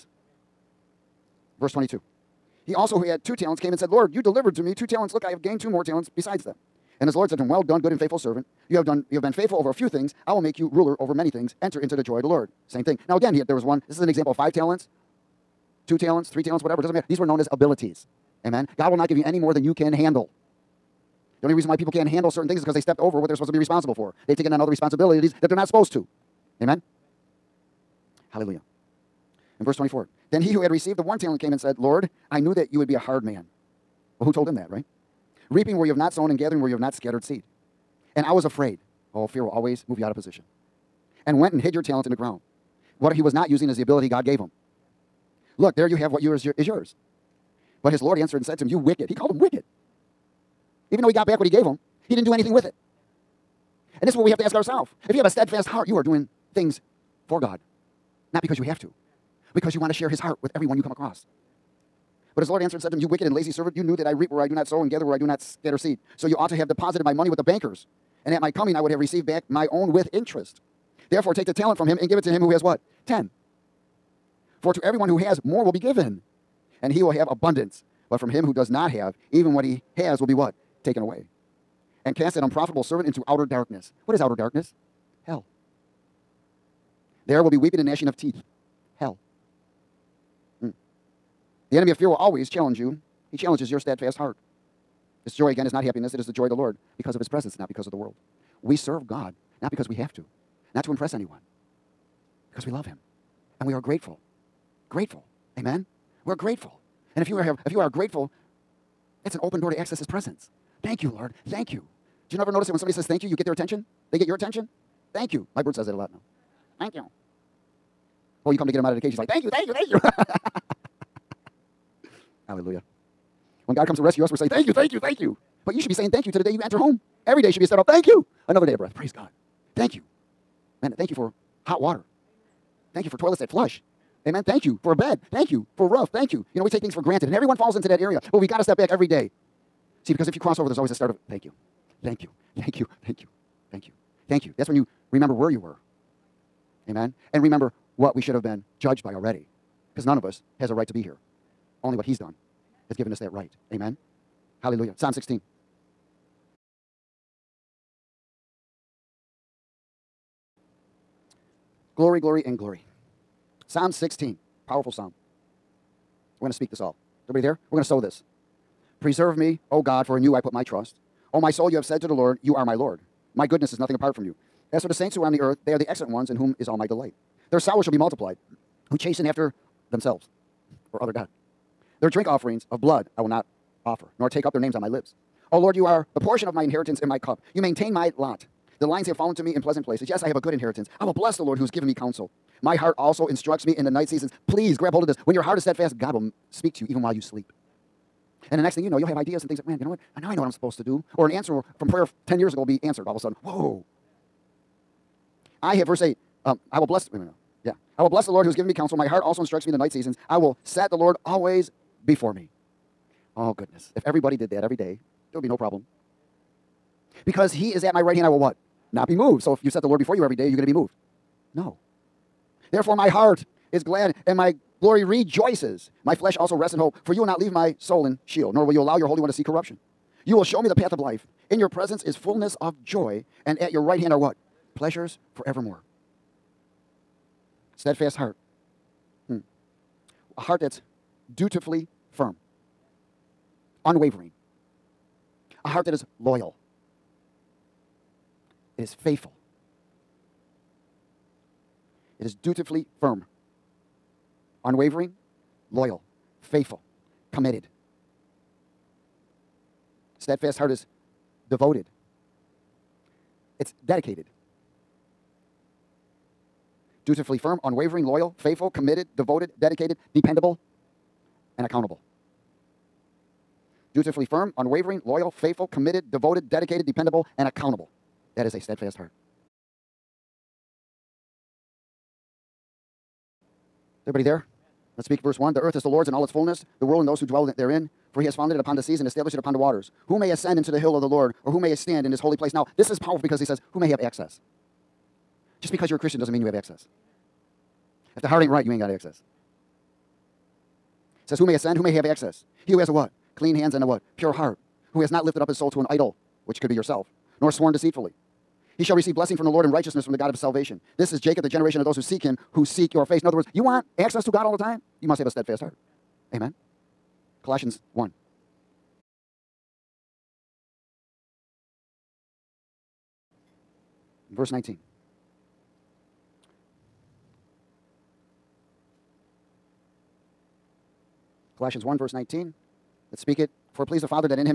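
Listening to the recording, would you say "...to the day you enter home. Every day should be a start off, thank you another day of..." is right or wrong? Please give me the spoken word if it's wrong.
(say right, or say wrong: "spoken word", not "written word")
right.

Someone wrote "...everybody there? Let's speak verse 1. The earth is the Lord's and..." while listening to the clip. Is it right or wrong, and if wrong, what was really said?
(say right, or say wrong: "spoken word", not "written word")
right.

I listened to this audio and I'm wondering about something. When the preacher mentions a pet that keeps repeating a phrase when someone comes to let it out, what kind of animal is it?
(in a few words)
bird.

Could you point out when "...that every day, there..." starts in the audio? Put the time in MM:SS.
03:34.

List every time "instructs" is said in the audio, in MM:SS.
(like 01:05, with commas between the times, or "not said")
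03:13, 03:29.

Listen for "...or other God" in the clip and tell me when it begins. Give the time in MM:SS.
03:00.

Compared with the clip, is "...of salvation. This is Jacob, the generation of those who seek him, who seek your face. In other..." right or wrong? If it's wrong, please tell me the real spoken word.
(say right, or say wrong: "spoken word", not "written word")
right.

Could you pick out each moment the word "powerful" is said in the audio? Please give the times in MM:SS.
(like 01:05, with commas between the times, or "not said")
02:44, 04:52.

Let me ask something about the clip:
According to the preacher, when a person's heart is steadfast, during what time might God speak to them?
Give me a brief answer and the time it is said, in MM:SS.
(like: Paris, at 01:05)
while you sleep, at 03:17.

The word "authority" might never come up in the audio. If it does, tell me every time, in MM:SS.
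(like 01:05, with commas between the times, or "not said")
not said.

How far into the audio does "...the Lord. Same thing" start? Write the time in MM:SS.
00:12.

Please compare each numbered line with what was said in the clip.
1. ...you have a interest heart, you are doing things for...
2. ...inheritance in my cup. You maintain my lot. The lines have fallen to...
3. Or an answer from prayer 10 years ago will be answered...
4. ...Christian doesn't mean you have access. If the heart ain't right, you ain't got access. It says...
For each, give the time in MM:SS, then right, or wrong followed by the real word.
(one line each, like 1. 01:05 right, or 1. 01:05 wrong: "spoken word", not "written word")
1. 00:55 wrong: "steadfast", not "interest"
2. 03:06 right
3. 03:21 right
4. 04:55 right.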